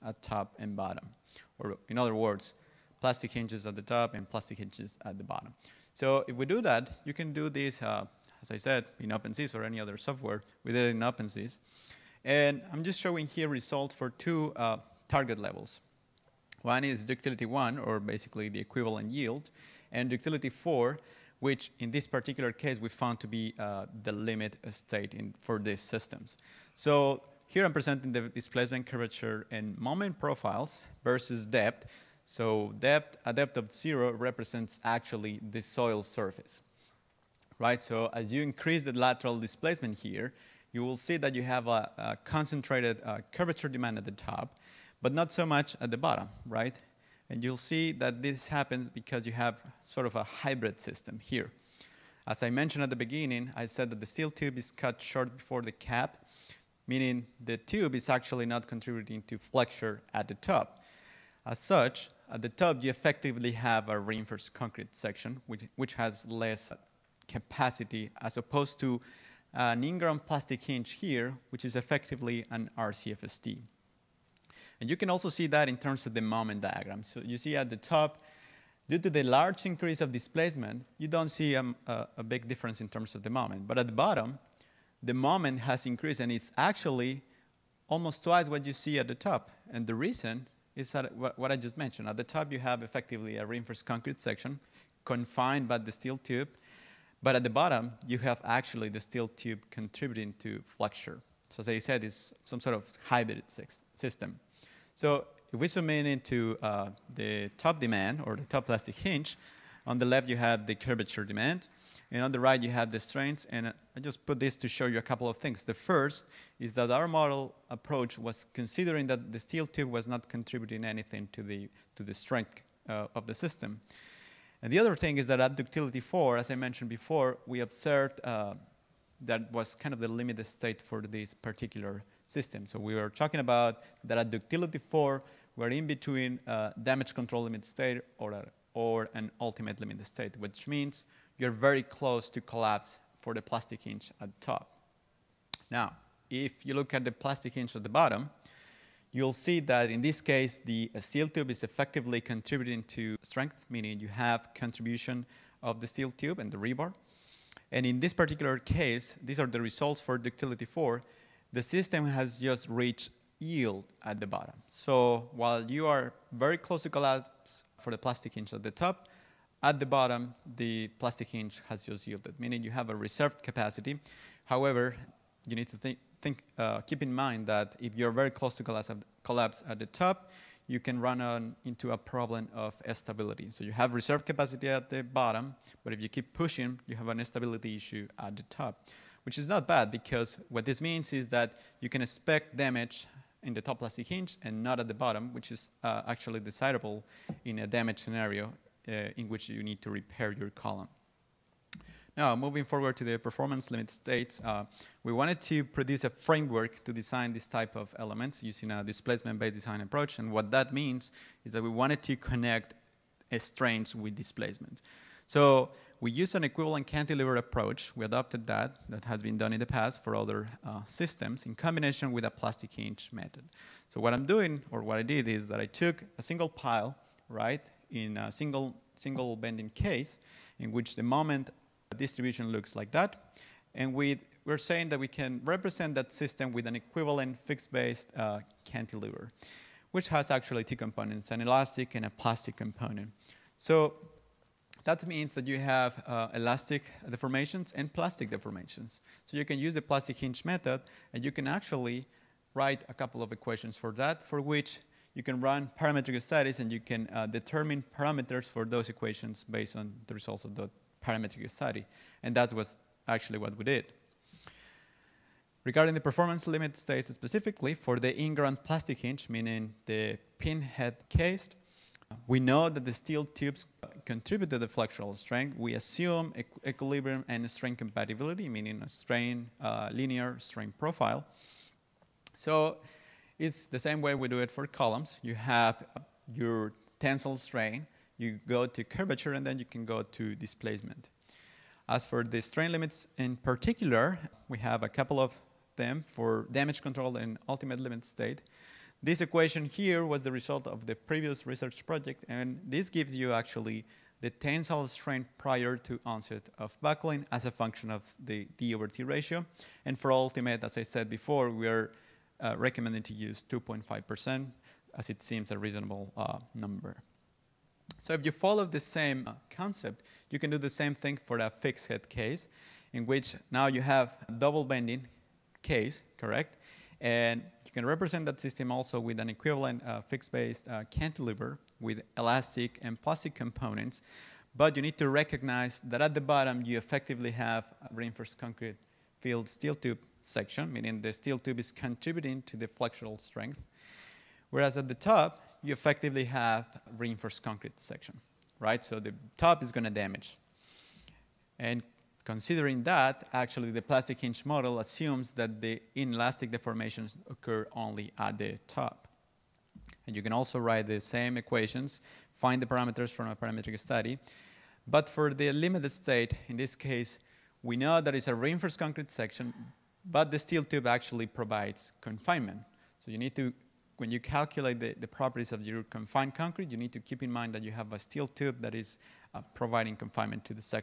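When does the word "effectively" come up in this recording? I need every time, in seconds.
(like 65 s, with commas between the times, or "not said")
62 s, 71 s, 92 s, 151 s, 336 s, 345 s.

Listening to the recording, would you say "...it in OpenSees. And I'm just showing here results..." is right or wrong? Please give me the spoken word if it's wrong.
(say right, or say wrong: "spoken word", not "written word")
right.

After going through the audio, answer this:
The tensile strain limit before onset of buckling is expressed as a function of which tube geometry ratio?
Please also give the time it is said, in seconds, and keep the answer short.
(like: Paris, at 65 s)
D over T, at 308 s.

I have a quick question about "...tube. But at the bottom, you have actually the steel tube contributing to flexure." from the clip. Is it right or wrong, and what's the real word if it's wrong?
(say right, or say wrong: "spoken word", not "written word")
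right.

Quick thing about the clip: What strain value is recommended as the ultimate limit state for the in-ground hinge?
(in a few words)
2.5%.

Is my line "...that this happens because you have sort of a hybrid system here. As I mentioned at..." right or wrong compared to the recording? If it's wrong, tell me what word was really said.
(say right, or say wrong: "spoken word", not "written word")
right.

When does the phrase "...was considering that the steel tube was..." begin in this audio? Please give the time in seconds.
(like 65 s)
118 s.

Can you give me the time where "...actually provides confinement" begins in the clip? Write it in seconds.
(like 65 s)
370 s.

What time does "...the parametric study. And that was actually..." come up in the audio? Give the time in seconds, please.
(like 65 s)
260 s.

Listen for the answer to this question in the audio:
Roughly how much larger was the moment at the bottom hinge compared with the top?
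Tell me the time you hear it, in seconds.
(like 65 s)
87 s.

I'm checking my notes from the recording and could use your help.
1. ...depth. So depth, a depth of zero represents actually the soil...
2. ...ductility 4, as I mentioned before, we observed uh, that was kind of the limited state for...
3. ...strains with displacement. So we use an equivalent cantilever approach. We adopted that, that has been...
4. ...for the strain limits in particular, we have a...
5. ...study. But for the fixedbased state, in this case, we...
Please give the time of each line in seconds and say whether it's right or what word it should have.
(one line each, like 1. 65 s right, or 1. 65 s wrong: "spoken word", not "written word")
1. 31 s right
2. 125 s right
3. 213 s right
4. 292 s right
5. 363 s wrong: "limited", not "fixedbased".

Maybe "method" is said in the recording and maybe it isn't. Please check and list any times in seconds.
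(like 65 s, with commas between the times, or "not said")
223 s, 250 s.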